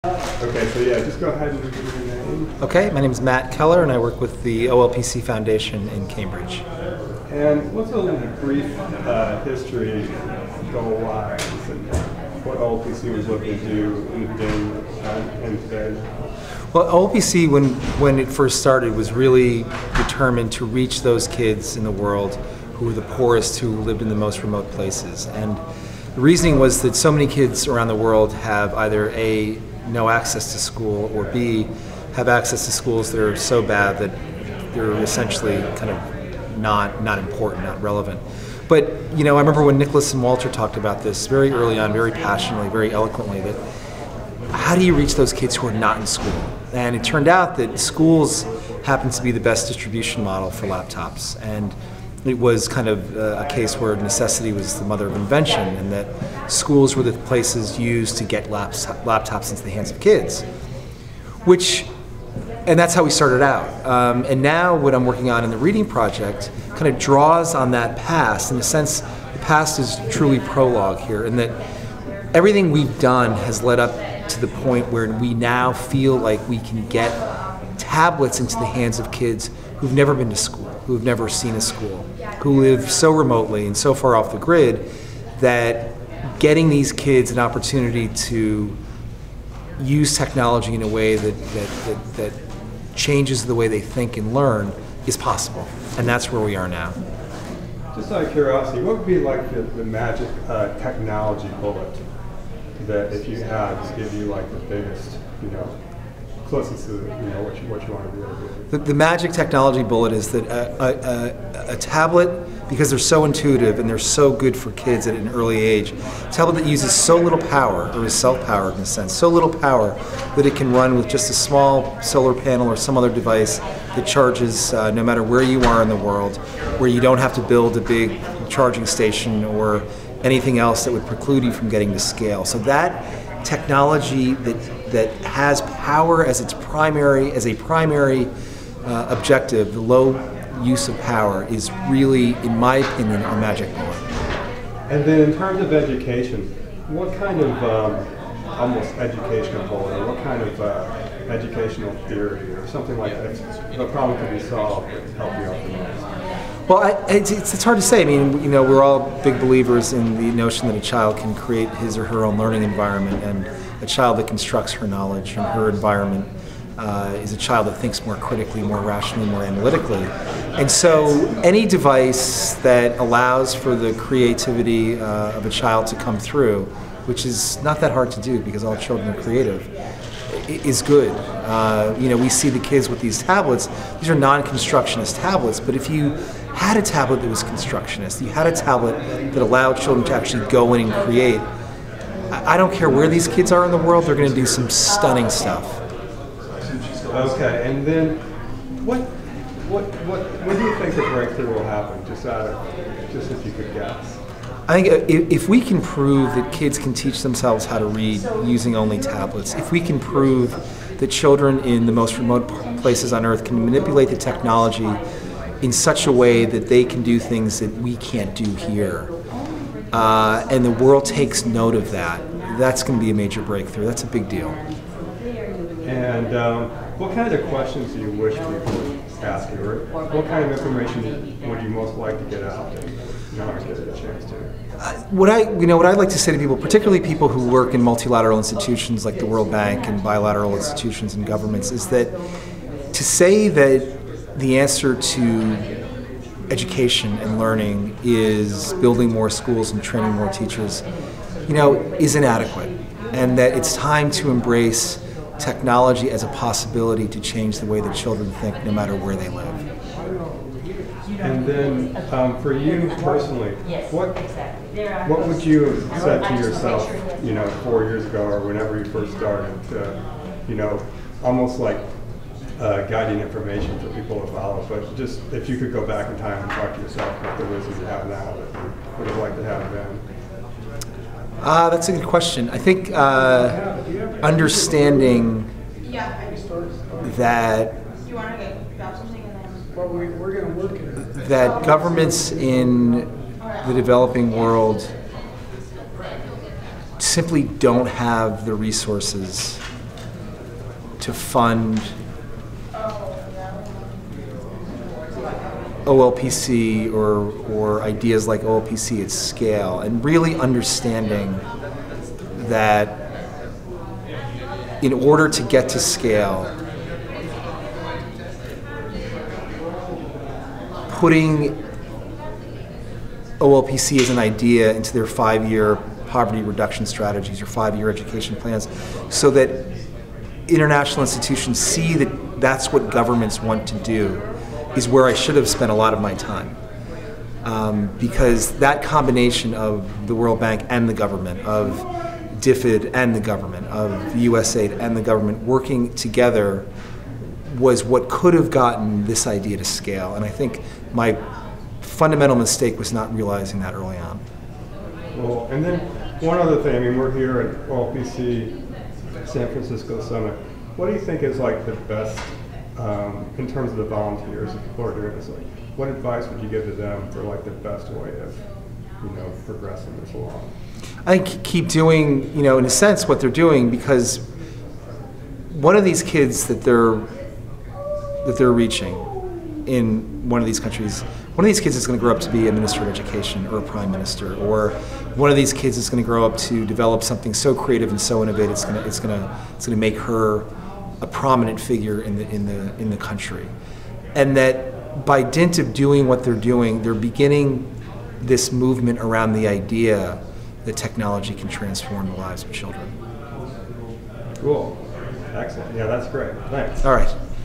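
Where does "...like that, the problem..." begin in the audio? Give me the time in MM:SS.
02:32.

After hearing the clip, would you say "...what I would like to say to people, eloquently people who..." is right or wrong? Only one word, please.
wrong.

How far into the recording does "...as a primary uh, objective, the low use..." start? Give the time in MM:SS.
02:17.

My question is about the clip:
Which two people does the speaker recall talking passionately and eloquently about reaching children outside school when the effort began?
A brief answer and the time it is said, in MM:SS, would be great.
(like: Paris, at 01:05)
Nicholas and Walter, at 00:39.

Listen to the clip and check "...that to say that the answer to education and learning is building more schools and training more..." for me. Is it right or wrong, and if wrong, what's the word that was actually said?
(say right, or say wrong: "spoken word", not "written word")
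right.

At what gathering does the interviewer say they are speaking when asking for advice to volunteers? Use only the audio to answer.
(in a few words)
OLPC San Francisco Summit.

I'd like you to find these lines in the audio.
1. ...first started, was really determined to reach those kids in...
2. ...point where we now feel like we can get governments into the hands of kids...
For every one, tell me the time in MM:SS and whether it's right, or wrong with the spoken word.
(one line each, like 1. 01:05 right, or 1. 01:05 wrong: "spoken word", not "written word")
1. 00:18 right
2. 01:14 wrong: "tablets", not "governments".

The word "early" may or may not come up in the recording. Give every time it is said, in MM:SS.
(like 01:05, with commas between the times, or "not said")
00:41, 01:55, 05:53.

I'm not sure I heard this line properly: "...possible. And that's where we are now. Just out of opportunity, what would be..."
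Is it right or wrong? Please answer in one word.
wrong.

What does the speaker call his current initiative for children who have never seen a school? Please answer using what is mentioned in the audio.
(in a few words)
the reading project.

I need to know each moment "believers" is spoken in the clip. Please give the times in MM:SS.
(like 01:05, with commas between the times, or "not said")
02:39.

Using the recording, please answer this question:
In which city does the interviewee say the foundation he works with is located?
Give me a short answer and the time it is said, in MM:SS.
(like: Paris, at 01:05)
Cambridge, at 00:06.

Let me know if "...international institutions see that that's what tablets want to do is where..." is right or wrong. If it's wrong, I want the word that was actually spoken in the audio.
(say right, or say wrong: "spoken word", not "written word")
wrong: "governments", not "tablets".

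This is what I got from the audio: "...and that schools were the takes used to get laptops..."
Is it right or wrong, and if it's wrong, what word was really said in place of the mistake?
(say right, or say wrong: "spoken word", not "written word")
wrong: "places", not "takes".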